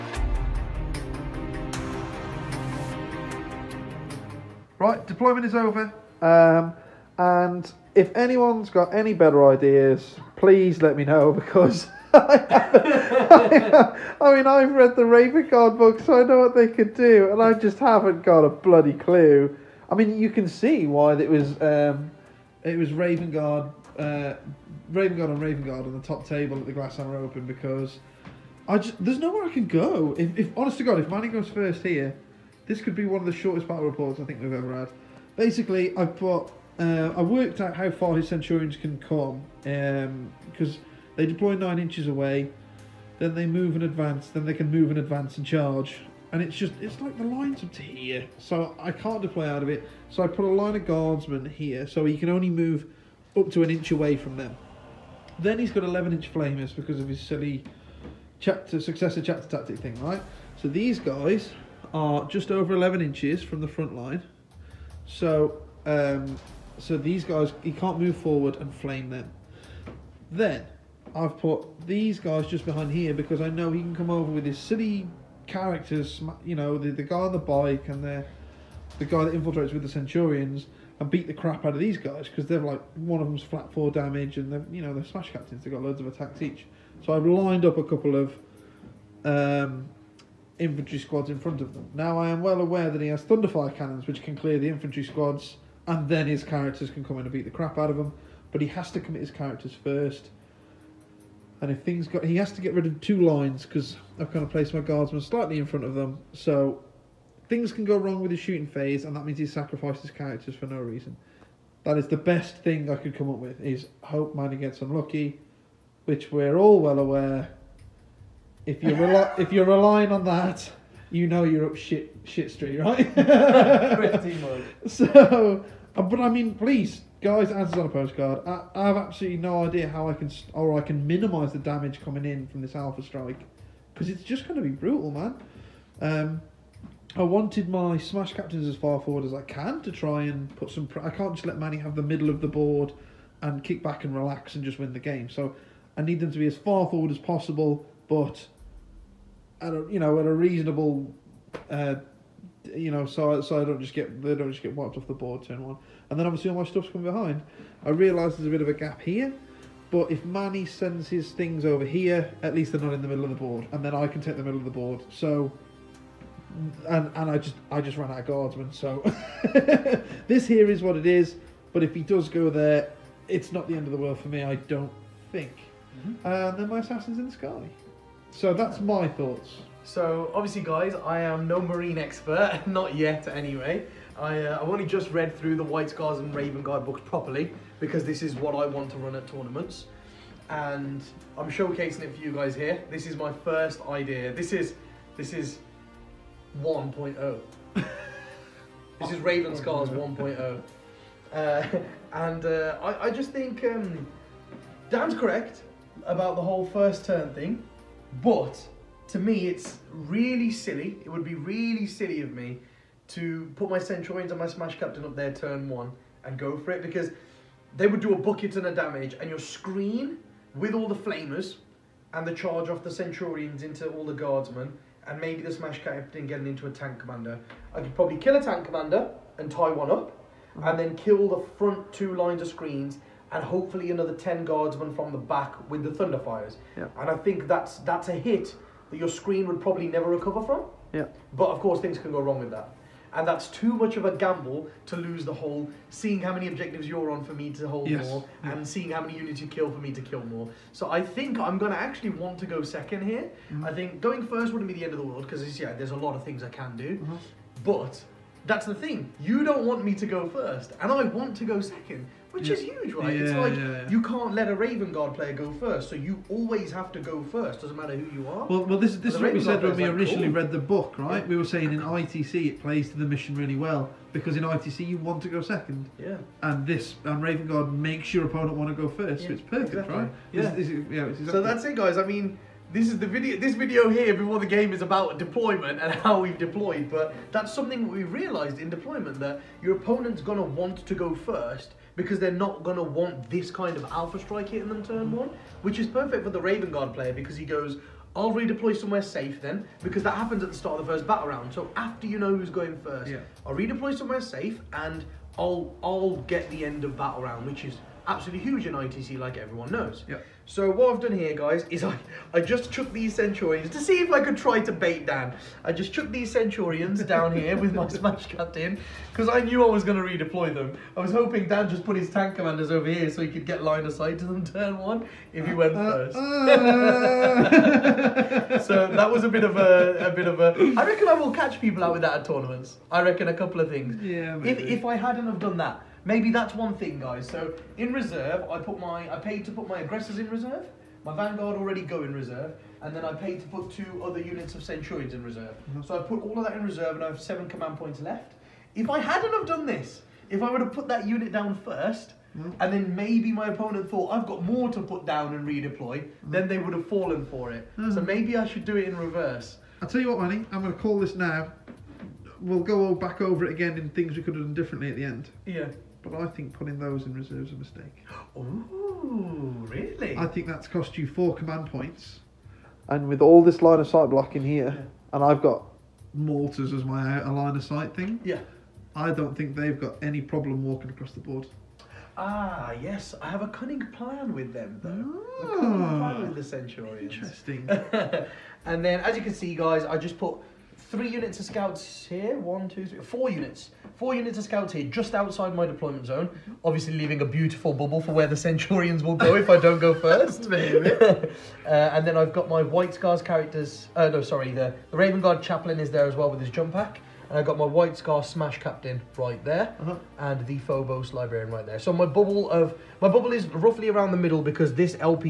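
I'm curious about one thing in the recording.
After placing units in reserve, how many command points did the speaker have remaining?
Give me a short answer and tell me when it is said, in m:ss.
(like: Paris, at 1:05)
7, at 5:47.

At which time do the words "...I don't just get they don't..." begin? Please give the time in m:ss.
2:33.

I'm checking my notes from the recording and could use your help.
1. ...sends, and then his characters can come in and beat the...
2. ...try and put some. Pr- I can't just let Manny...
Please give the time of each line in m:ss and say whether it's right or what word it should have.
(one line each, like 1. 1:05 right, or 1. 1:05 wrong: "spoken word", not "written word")
1. 1:35 wrong: "squads", not "sends"
2. 2:19 right.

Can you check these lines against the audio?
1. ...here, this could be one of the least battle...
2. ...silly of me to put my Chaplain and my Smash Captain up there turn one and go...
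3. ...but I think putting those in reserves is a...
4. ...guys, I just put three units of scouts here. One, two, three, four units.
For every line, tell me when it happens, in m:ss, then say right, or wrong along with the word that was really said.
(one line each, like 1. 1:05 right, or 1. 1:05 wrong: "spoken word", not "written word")
1. 0:31 wrong: "shortest", not "least"
2. 3:31 wrong: "Centurions", not "Chaplain"
3. 6:06 right
4. 6:29 right.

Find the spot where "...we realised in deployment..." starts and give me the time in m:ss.
4:47.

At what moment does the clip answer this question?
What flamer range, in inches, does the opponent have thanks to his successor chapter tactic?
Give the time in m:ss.
0:55.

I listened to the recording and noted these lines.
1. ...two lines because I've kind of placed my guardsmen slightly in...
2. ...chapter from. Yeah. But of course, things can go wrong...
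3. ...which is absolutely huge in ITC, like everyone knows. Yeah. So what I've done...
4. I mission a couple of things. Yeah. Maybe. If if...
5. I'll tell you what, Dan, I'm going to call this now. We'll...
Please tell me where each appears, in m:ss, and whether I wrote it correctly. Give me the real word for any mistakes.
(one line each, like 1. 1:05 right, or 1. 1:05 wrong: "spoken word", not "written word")
1. 1:42 right
2. 4:00 wrong: "recover", not "chapter"
3. 5:07 right
4. 5:32 wrong: "reckon", not "mission"
5. 5:59 wrong: "Manny", not "Dan".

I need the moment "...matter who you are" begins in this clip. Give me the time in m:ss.
4:27.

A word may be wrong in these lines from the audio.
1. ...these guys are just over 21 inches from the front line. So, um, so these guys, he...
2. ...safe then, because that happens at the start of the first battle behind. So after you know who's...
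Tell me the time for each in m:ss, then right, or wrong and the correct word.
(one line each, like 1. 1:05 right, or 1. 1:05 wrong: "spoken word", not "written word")
1. 1:00 wrong: "11", not "21"
2. 4:59 wrong: "round", not "behind".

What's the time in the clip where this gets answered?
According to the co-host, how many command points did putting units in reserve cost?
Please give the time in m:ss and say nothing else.
6:11.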